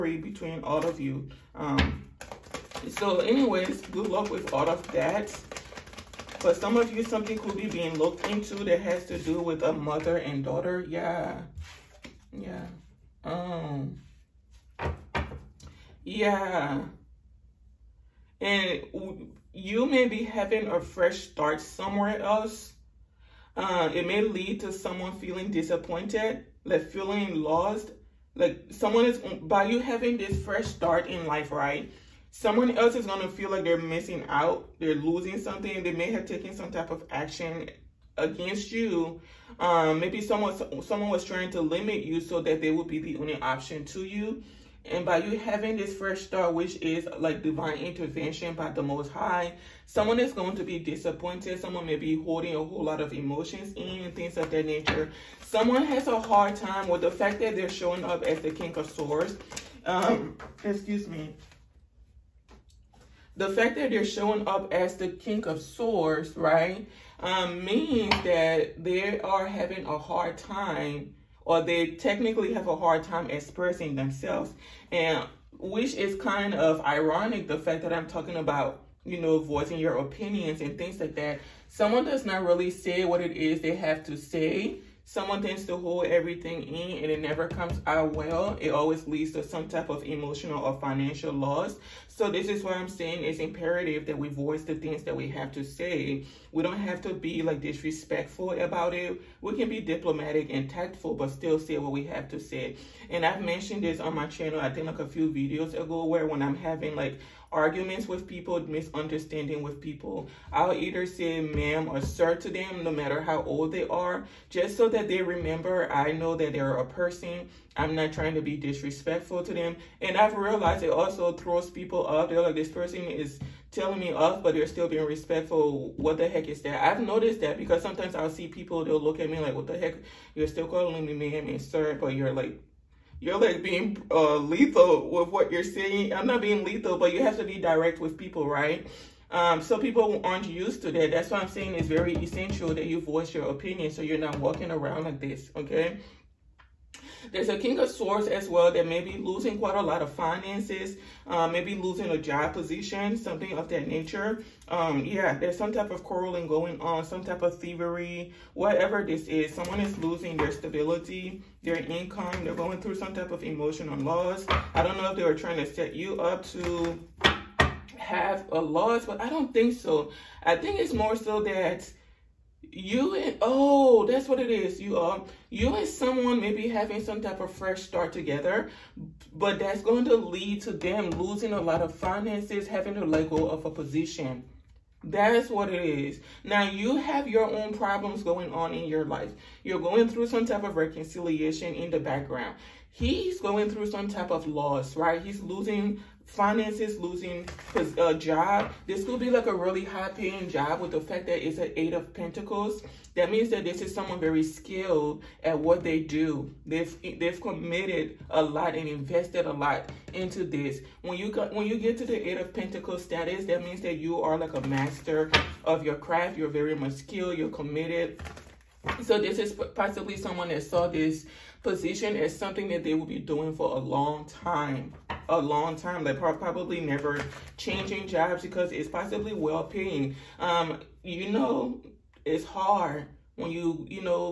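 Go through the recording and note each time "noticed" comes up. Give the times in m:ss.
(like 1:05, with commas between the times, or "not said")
2:07.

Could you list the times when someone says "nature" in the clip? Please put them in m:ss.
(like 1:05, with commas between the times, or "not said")
0:54, 2:33.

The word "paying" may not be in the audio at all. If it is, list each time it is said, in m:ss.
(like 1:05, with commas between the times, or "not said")
3:20, 3:49.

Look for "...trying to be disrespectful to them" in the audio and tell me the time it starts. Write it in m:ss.
1:58.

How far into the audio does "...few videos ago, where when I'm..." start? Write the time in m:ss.
1:45.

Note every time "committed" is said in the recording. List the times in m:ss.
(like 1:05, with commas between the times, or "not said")
3:27, 3:37.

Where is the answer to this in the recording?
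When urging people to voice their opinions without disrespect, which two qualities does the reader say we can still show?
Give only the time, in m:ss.
1:39.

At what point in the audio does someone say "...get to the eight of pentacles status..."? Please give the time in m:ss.
3:31.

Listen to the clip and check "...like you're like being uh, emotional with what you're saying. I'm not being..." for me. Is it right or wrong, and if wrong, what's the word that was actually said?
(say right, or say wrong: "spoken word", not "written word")
wrong: "lethal", not "emotional".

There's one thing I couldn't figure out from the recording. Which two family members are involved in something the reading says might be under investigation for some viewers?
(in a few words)
Mother and daughter.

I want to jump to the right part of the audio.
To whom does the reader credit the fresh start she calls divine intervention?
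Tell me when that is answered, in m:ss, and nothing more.
0:48.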